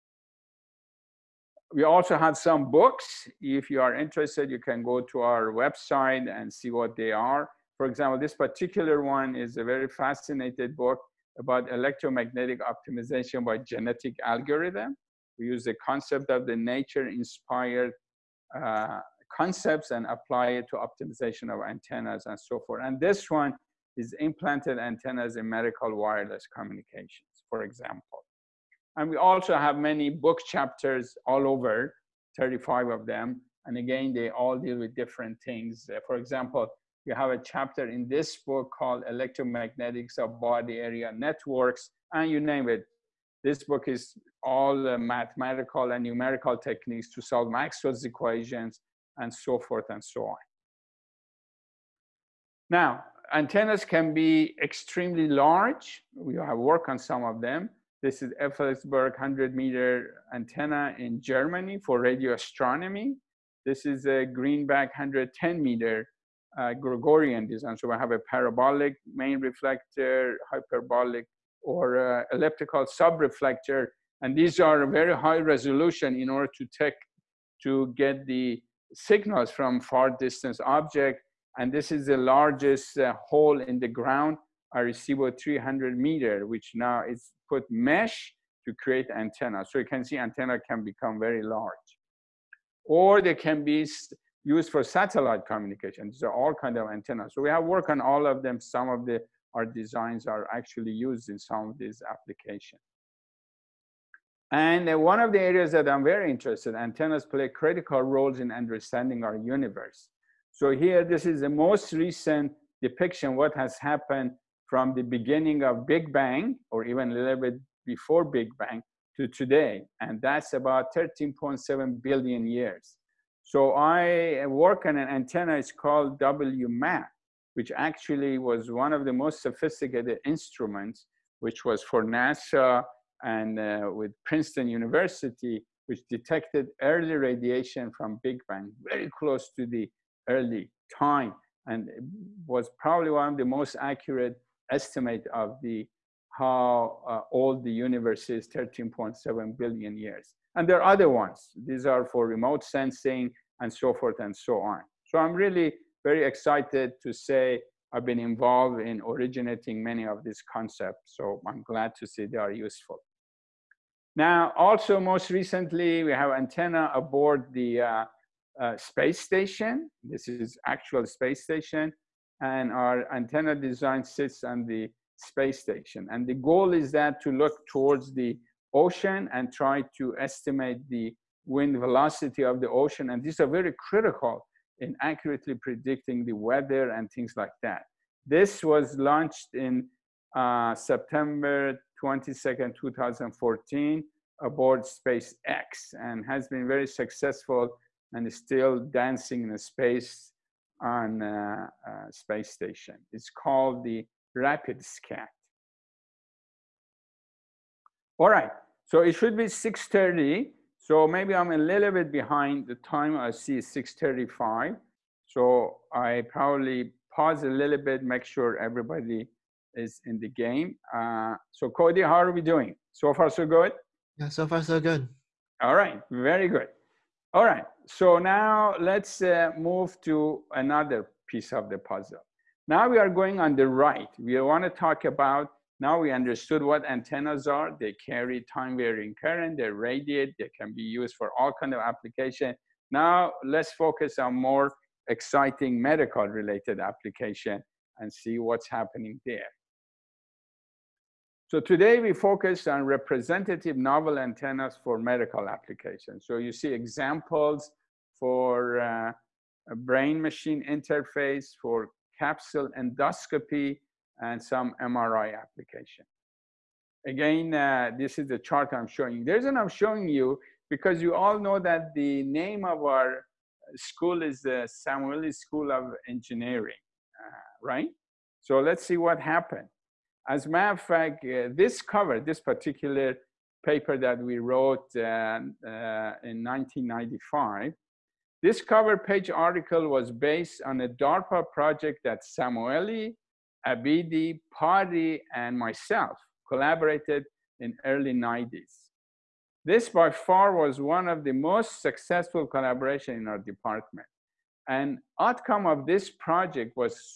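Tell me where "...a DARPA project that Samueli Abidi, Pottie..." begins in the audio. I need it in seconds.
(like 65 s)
290 s.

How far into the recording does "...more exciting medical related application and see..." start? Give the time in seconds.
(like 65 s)
244 s.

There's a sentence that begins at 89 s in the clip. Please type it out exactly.
So you can see antenna can become very large.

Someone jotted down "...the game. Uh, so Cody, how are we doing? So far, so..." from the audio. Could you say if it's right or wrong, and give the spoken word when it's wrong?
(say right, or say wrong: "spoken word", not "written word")
right.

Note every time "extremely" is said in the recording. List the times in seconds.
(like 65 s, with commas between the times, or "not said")
54 s.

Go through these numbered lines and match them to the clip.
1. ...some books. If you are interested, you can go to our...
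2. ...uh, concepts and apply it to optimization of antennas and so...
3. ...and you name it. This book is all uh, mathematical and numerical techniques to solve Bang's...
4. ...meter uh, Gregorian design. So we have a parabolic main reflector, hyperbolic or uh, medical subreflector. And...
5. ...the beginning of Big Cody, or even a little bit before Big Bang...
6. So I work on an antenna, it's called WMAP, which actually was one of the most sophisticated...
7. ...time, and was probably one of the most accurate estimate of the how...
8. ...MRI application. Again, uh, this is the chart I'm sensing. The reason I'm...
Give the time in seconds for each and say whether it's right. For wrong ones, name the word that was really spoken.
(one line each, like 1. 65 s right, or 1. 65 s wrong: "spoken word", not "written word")
1. 2 s right
2. 18 s right
3. 42 s wrong: "Maxwell", not "Bang"
4. 65 s wrong: "elliptical", not "medical"
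5. 114 s wrong: "Bang", not "Cody"
6. 123 s right
7. 140 s right
8. 264 s wrong: "showing", not "sensing".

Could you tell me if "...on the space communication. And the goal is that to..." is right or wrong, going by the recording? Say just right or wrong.
wrong.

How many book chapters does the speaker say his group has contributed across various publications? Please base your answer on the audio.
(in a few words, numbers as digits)
35.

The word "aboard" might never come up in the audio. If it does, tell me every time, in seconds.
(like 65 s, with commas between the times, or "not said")
166 s, 194 s.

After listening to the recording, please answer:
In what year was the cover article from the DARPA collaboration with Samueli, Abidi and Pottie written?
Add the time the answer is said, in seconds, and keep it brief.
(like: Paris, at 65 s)
1995, at 286 s.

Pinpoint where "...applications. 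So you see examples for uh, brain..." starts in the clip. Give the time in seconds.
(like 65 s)
255 s.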